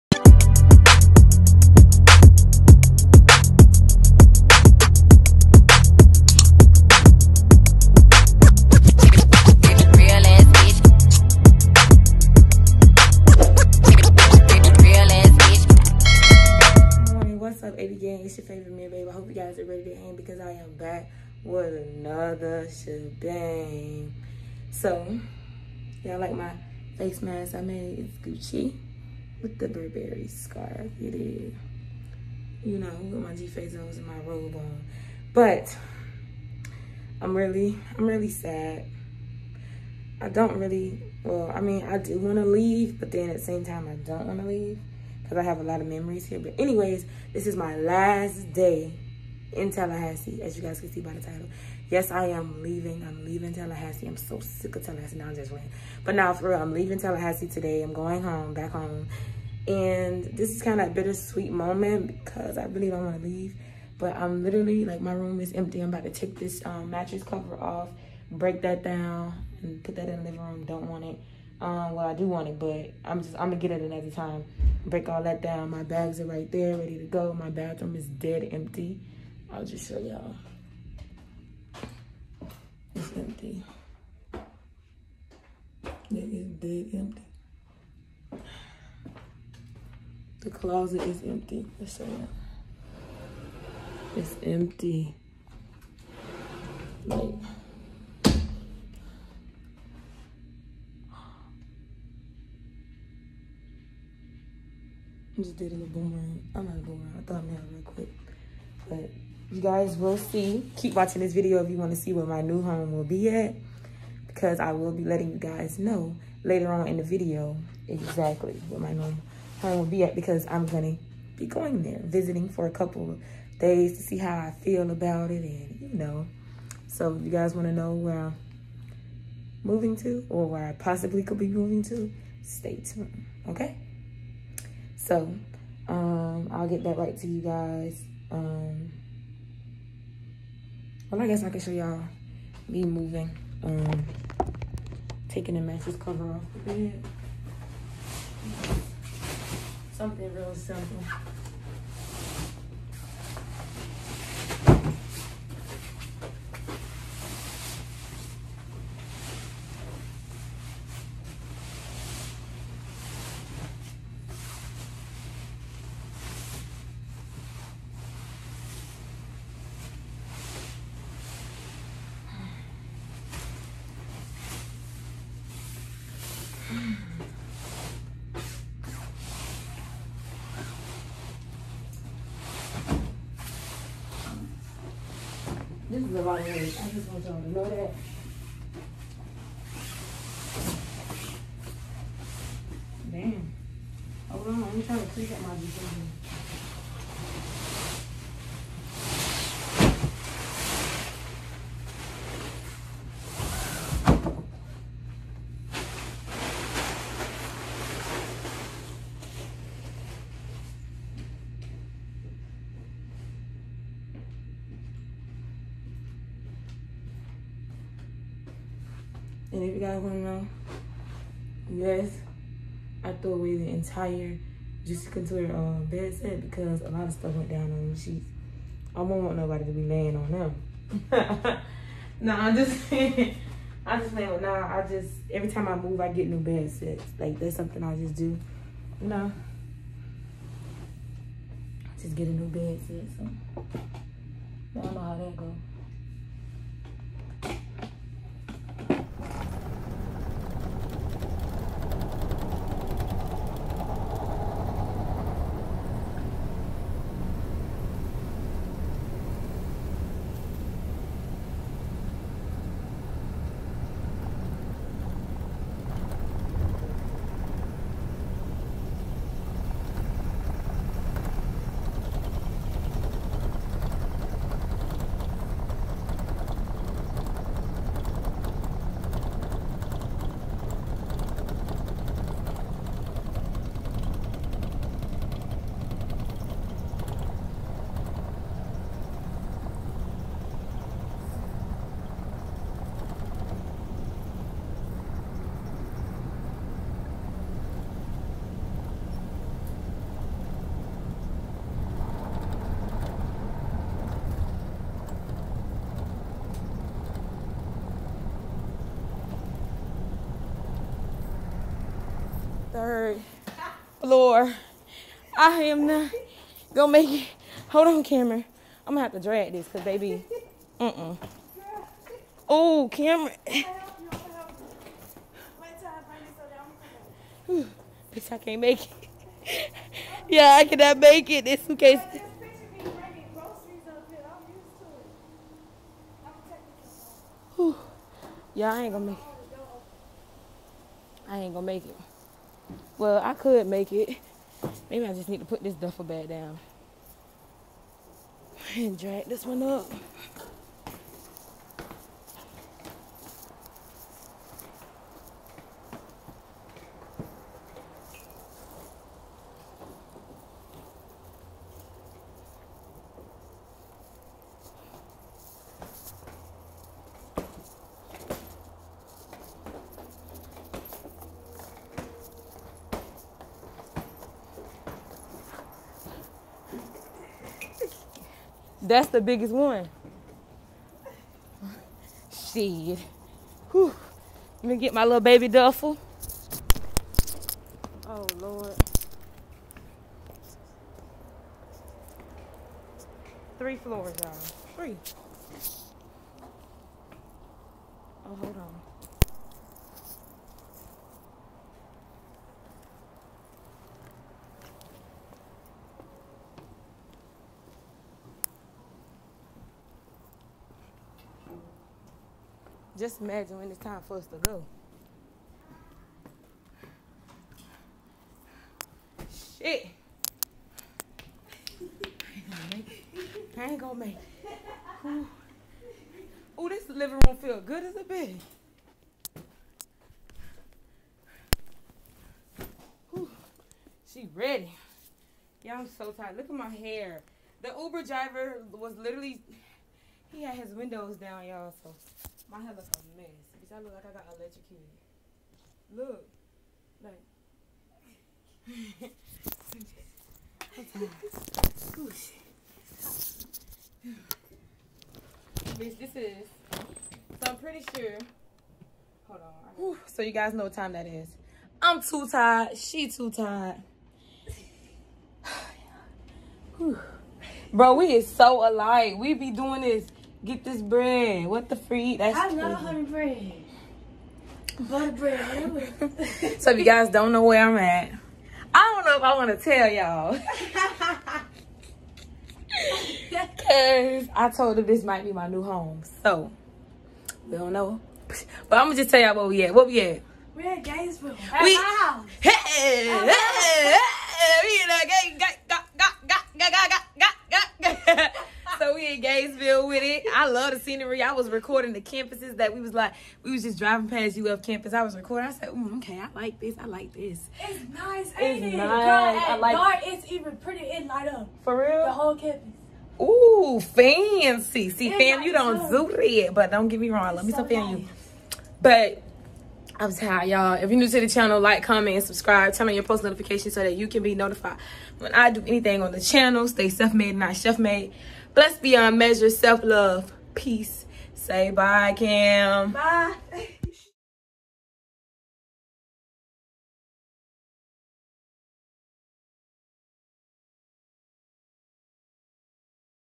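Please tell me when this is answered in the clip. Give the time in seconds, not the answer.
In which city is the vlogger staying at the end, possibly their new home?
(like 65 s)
490 s.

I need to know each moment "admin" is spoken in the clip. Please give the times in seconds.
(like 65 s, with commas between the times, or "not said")
not said.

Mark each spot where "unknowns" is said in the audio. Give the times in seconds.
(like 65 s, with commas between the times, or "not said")
not said.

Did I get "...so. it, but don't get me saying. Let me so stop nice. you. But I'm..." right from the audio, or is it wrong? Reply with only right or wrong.
wrong.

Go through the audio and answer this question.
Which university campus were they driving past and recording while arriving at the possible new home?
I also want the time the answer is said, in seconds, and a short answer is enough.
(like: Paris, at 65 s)
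UF, at 504 s.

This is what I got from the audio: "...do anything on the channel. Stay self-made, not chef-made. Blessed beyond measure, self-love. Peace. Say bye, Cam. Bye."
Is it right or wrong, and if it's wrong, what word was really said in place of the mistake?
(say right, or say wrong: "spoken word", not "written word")
right.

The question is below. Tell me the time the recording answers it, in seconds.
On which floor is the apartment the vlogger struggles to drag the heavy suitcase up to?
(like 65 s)
312 s.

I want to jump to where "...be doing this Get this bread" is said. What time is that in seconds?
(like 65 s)
469 s.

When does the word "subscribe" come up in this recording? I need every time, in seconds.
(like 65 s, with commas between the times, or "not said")
522 s.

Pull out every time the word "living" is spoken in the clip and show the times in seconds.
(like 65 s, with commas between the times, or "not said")
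70 s, 426 s.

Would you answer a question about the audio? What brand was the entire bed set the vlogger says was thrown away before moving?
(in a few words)
Juicy Couture.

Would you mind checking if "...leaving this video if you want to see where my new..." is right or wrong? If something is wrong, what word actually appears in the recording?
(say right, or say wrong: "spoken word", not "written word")
wrong: "watching", not "leaving".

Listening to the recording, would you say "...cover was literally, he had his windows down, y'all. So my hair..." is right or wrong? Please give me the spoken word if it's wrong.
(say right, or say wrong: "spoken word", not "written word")
wrong: "driver", not "cover".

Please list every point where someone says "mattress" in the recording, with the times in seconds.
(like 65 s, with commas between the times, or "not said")
66 s, 145 s.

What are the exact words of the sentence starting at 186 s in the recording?
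this is the wrong I just want y'all to know that.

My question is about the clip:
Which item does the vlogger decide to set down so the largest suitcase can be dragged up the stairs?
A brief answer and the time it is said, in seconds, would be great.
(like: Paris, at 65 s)
Duffel bag, at 345 s.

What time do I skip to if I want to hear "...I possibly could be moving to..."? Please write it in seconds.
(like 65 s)
130 s.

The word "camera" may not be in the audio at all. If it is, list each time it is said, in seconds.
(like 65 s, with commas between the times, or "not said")
318 s, 322 s.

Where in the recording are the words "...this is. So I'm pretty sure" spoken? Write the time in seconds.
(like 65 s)
455 s.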